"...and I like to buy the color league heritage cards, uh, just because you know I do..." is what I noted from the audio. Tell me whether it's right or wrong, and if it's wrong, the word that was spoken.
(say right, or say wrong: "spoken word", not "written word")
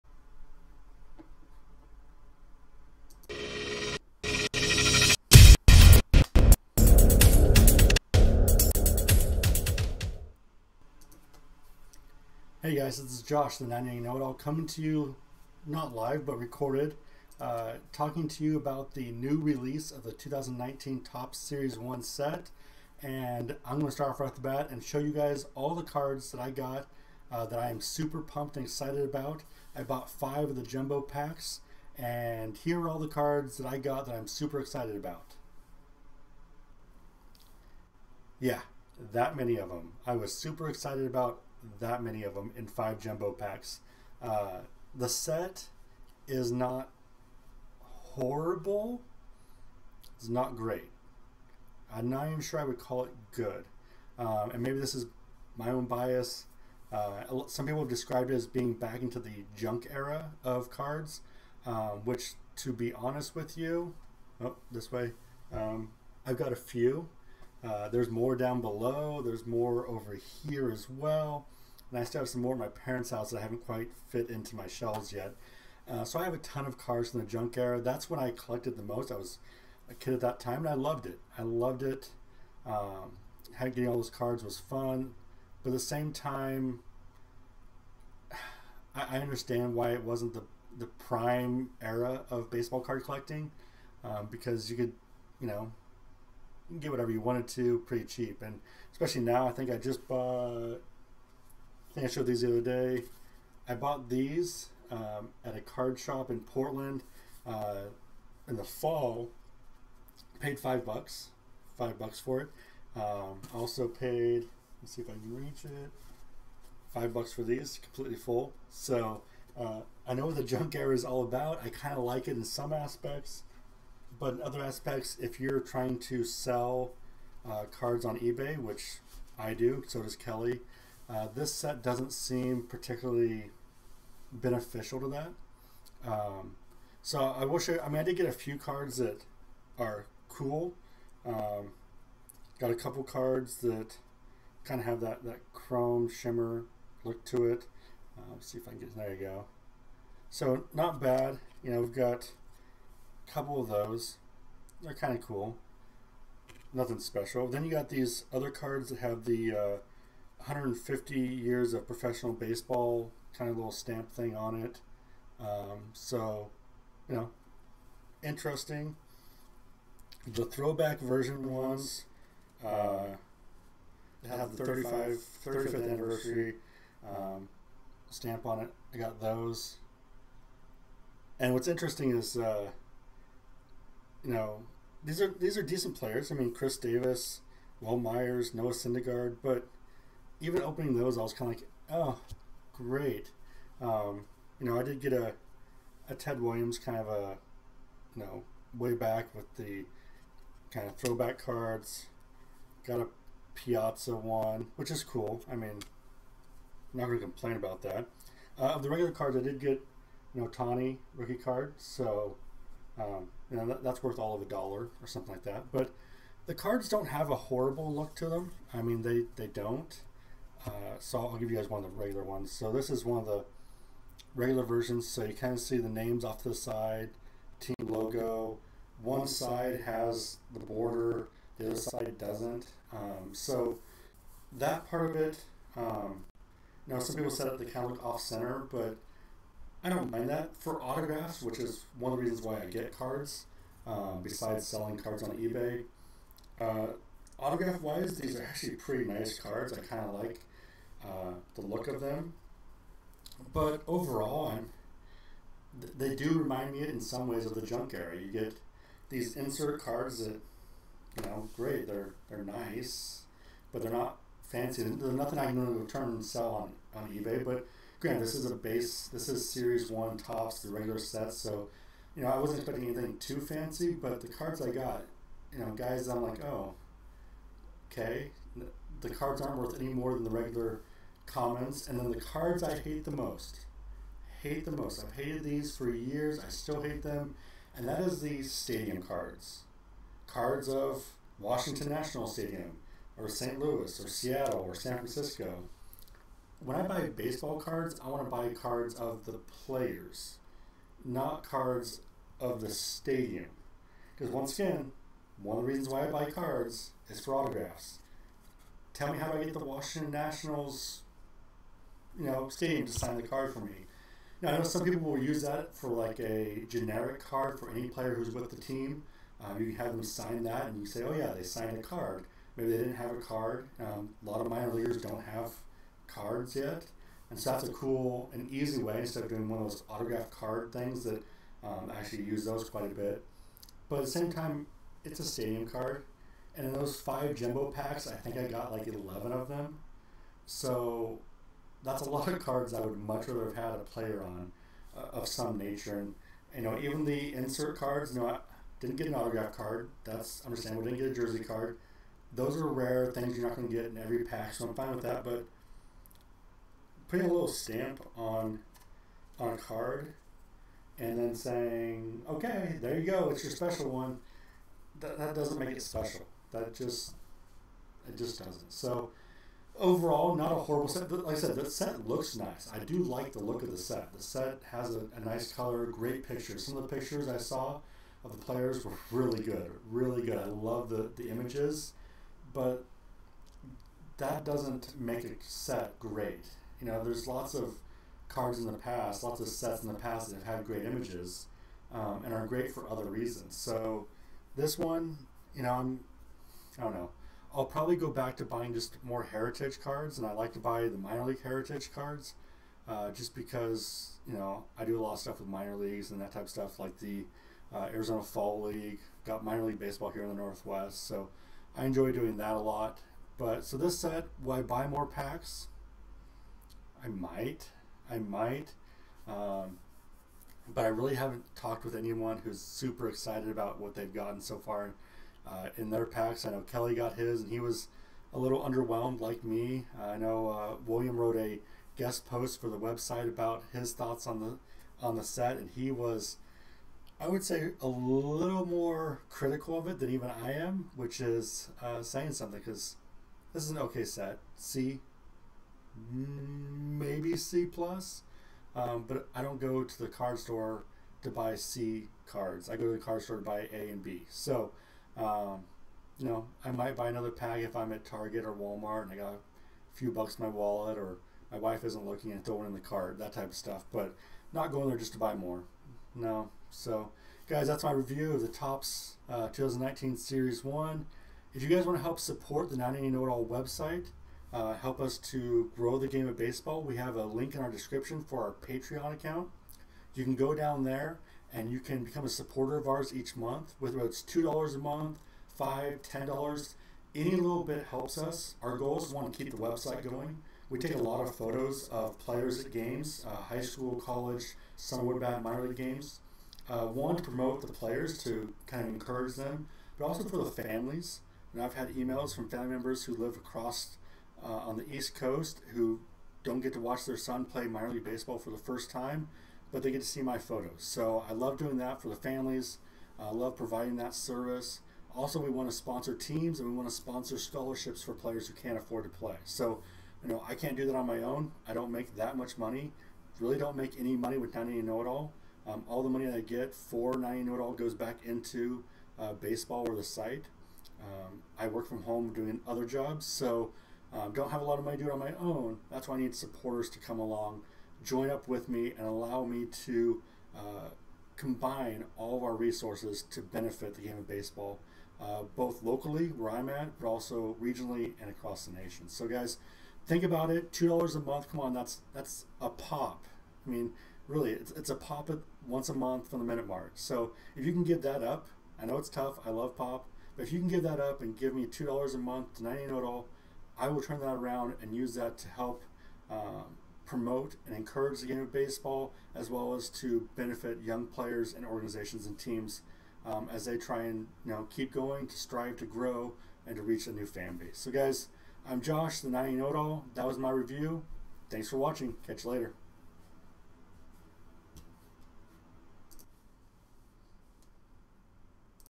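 wrong: "minor", not "color".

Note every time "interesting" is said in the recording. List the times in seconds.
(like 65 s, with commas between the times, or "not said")
168 s, 181 s.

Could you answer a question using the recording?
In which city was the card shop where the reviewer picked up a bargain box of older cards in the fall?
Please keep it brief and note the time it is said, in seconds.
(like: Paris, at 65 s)
Portland, at 106 s.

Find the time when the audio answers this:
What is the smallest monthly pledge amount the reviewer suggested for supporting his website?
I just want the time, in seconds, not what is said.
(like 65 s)
484 s.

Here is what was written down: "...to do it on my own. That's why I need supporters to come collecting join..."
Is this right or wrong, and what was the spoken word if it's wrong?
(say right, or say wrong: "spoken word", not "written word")
wrong: "along", not "collecting".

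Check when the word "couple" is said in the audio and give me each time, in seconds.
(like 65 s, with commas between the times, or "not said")
142 s, 153 s.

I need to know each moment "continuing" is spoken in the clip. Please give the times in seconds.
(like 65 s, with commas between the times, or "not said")
not said.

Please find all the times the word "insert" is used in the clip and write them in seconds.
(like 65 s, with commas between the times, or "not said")
259 s, 347 s.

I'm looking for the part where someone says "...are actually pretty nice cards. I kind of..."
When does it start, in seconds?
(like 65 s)
248 s.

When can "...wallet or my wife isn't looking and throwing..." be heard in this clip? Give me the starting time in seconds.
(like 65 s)
460 s.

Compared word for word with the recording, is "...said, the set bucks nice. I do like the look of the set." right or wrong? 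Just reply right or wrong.
wrong.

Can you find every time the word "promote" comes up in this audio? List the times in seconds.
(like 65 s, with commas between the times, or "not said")
497 s, 567 s.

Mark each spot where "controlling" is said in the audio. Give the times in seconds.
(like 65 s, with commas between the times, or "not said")
not said.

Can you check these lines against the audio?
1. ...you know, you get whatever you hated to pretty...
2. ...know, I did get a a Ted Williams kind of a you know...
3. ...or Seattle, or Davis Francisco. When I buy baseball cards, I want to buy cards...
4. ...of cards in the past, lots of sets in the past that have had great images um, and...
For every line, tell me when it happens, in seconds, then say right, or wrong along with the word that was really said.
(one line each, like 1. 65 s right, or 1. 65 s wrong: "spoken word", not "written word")
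1. 95 s wrong: "wanted", not "hated"
2. 194 s right
3. 294 s wrong: "San", not "Davis"
4. 387 s right.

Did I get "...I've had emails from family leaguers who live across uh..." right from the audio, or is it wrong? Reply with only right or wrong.
wrong.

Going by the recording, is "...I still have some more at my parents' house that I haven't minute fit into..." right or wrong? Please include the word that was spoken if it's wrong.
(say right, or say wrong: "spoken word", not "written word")
wrong: "quite", not "minute".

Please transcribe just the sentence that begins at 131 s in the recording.
Uh, this set doesn't seem particularly beneficial to that.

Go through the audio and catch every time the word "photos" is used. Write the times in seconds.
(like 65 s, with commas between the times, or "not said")
491 s, 510 s.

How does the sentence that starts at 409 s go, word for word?
Got minor league baseball here in the Northwest, so I enjoy doing that a lot.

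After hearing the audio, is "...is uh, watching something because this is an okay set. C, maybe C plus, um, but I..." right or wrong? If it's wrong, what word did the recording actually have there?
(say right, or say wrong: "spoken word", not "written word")
wrong: "saying", not "watching".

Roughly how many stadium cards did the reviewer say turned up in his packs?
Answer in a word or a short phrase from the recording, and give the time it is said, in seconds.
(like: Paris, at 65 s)
11, at 338 s.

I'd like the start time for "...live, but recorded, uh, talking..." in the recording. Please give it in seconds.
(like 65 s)
15 s.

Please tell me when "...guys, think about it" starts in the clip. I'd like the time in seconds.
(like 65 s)
549 s.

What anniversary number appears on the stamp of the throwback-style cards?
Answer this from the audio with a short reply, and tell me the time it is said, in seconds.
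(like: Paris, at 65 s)
35th, at 175 s.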